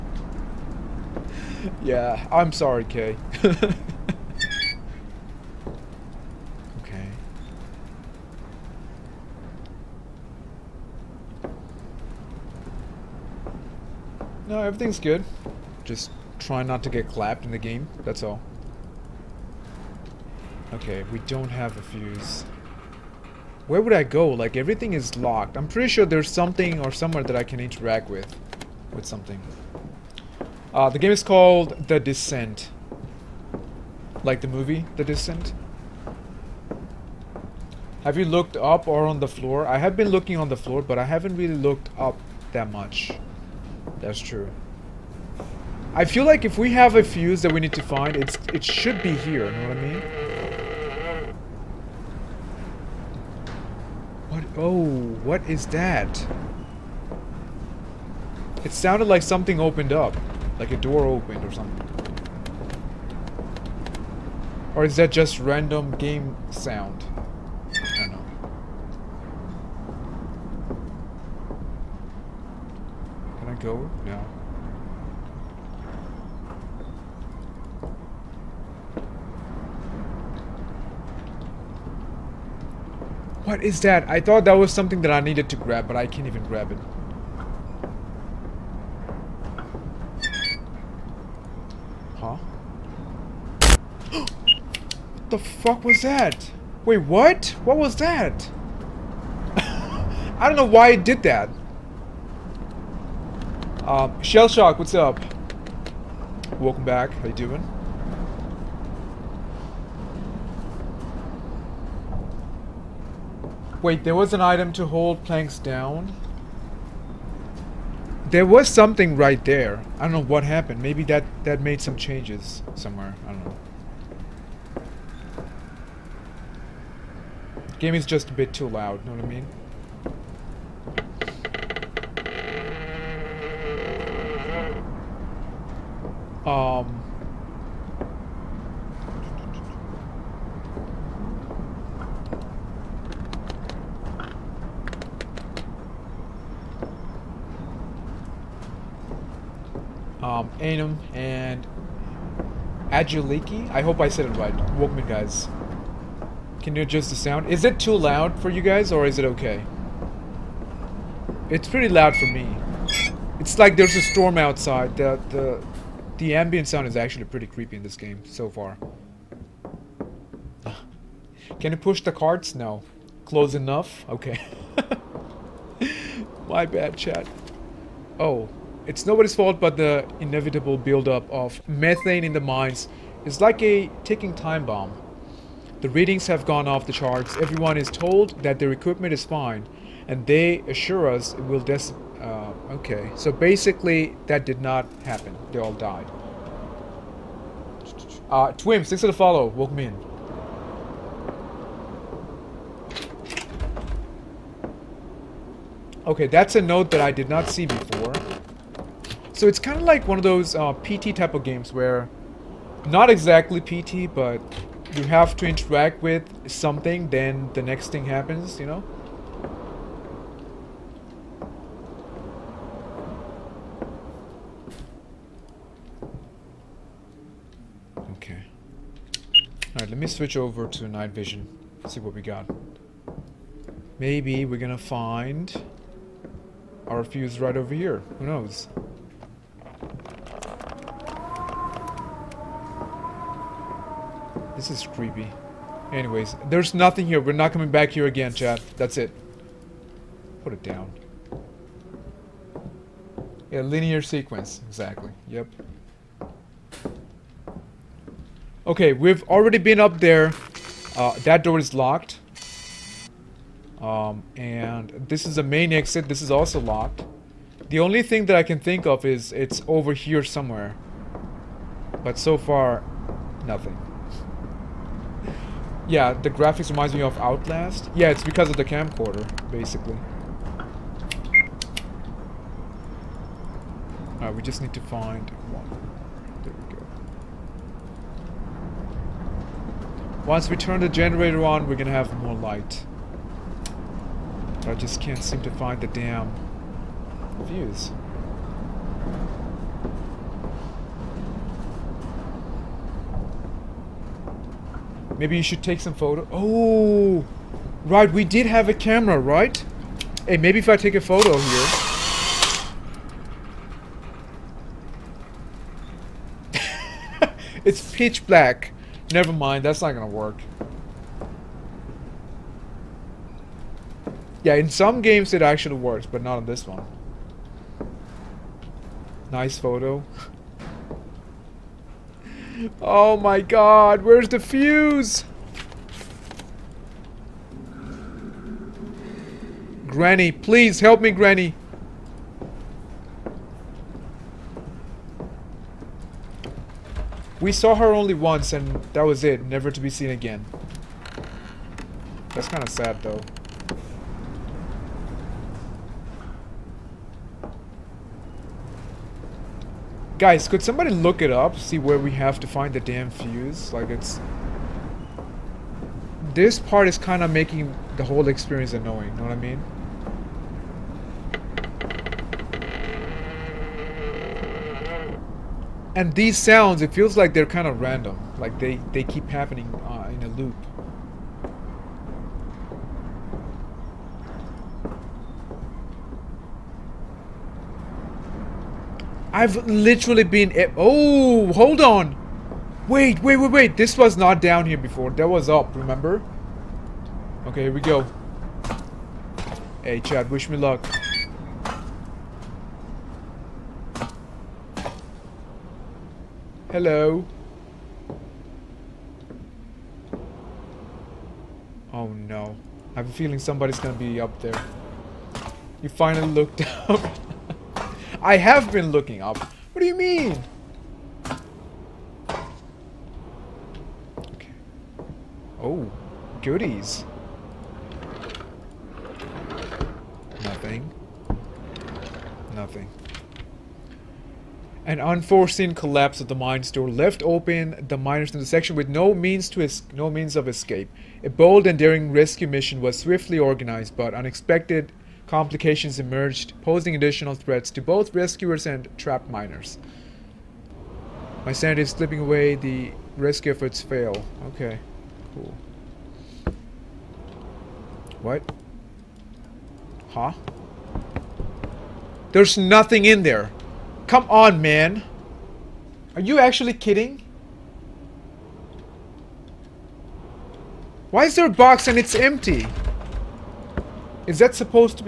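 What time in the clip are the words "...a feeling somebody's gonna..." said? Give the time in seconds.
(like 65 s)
413 s.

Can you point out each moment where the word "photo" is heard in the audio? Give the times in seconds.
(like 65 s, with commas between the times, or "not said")
305 s, 311 s, 329 s.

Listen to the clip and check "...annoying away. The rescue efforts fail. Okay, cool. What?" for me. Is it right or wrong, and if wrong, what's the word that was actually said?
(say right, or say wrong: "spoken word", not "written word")
wrong: "slipping", not "annoying".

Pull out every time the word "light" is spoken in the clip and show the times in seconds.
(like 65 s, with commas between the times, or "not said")
292 s.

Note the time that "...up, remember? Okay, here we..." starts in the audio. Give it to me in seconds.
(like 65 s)
395 s.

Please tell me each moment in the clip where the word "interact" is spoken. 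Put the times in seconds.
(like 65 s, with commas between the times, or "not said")
27 s, 215 s.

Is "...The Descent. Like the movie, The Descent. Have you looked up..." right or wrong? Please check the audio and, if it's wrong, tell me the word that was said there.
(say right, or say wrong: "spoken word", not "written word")
right.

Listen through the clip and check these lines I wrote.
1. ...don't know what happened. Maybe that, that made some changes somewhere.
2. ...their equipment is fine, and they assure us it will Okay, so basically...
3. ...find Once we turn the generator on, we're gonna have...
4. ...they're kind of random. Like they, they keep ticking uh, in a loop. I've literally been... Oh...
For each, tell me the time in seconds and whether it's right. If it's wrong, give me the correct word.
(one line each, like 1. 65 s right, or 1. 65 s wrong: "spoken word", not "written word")
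1. 120 s right
2. 188 s right
3. 284 s right
4. 377 s wrong: "happening", not "ticking".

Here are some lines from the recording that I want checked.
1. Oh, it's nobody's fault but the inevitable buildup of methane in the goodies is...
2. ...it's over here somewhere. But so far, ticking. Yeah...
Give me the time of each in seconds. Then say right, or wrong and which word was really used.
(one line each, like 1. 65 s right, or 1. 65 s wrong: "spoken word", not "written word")
1. 178 s wrong: "mines", not "goodies"
2. 269 s wrong: "nothing", not "ticking".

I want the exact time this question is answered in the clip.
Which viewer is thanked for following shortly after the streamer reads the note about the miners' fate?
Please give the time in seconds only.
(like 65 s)
198 s.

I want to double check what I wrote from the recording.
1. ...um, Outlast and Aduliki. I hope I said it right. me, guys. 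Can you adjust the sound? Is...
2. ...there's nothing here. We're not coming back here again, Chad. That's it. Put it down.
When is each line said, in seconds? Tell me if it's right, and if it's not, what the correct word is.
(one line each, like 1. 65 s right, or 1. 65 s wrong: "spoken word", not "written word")
1. 150 s wrong: "Anum", not "Outlast"
2. 246 s right.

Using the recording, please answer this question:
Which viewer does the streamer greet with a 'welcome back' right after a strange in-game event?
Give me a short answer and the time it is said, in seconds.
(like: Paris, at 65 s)
Shell Shock, at 104 s.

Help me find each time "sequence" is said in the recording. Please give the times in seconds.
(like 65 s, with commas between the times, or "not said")
254 s.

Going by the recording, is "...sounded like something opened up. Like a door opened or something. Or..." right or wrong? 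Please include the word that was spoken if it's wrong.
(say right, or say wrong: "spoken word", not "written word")
right.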